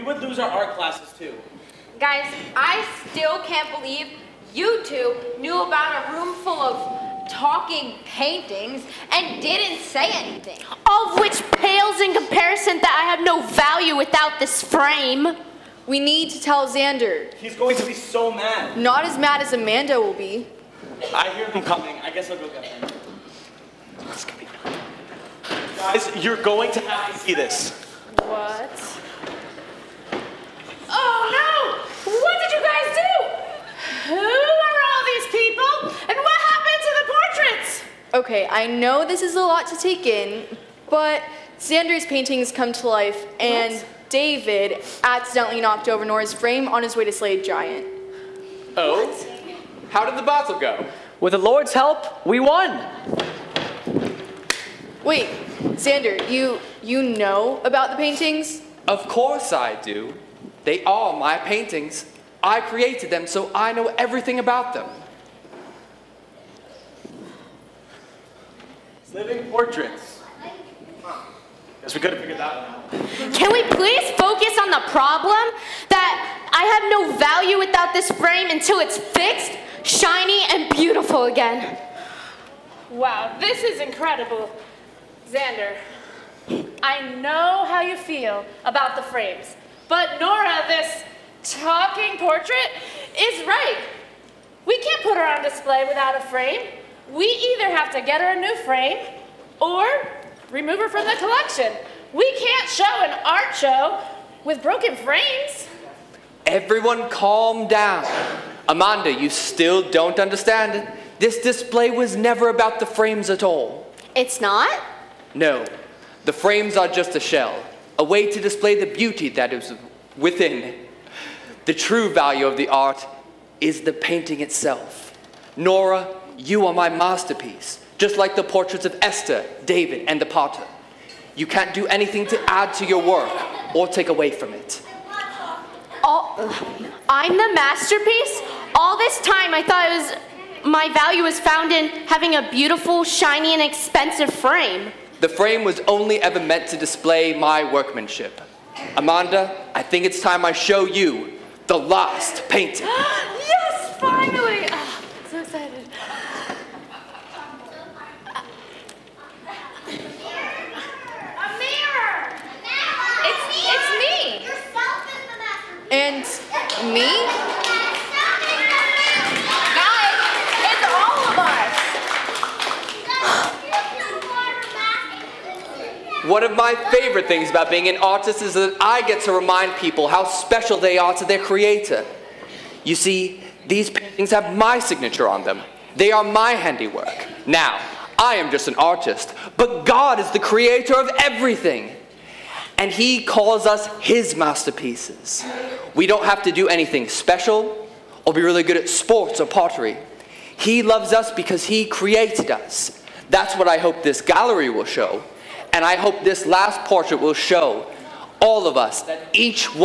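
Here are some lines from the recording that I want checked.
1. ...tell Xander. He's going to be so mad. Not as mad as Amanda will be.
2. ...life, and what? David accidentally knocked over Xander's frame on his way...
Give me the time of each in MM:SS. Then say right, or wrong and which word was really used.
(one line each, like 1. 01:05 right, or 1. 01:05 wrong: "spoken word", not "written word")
1. 00:16 right
2. 00:42 wrong: "Nora", not "Xander".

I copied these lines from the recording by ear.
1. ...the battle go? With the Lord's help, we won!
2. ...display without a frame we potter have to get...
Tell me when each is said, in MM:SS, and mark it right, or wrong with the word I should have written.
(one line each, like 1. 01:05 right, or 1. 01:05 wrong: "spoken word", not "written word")
1. 00:50 right
2. 01:35 wrong: "either", not "potter".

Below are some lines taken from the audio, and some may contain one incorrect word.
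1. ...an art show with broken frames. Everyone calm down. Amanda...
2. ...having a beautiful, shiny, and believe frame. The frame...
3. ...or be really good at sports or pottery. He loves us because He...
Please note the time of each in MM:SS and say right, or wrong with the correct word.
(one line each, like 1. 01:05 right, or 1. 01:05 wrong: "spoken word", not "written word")
1. 01:43 right
2. 02:22 wrong: "expensive", not "believe"
3. 03:18 right.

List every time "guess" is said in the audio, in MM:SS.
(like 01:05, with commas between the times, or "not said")
00:22, 01:11.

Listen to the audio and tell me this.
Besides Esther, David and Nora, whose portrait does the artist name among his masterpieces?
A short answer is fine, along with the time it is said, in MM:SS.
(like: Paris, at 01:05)
the potter, at 02:10.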